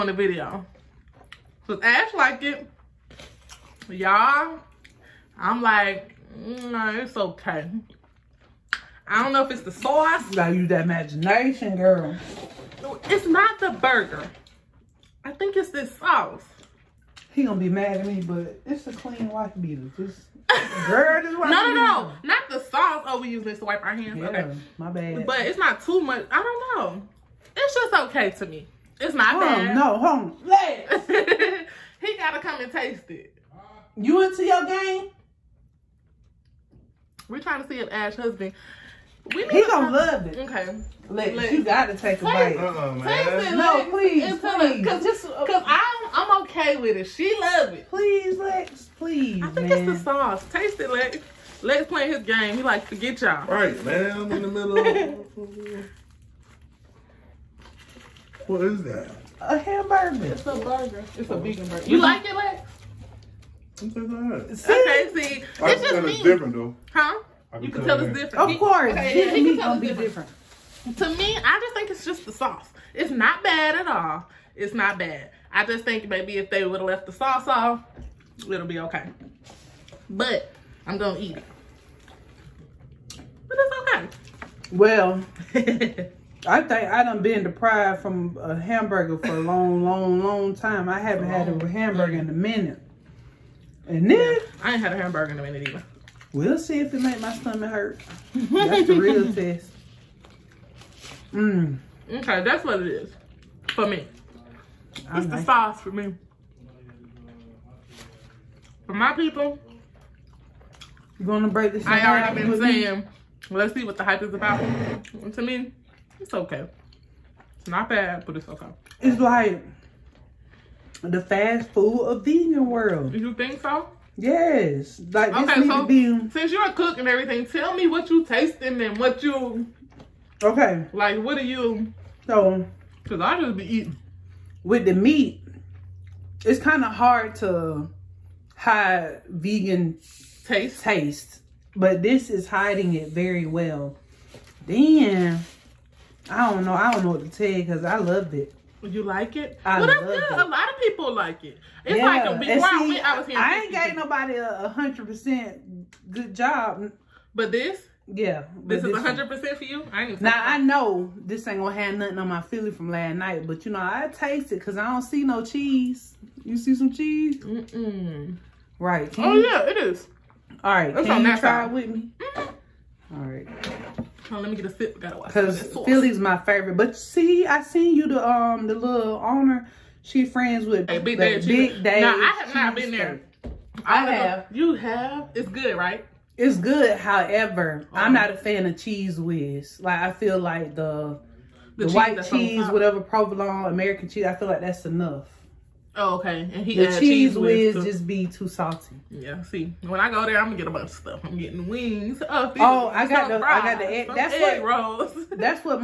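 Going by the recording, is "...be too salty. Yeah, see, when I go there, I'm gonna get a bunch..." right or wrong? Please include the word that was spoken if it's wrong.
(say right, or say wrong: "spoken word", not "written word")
right.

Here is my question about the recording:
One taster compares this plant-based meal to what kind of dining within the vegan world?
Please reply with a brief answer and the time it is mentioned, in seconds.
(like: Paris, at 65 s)
Fast food, at 121 s.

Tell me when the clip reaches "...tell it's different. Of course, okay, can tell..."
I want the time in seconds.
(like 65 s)
67 s.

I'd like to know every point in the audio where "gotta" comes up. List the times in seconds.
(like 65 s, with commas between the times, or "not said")
10 s, 32 s, 41 s, 174 s.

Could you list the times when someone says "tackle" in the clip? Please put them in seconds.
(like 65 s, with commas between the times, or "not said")
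not said.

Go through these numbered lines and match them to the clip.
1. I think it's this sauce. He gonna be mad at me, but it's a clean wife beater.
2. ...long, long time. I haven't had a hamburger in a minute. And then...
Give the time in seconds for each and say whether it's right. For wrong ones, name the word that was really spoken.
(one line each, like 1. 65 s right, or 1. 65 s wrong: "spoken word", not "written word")
1. 15 s right
2. 89 s right.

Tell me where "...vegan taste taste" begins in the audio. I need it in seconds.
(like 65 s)
139 s.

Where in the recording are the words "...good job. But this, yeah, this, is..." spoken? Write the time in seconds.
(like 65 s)
156 s.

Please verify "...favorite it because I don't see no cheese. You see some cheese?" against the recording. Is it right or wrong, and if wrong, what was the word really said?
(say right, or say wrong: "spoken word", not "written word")
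wrong: "taste", not "favorite".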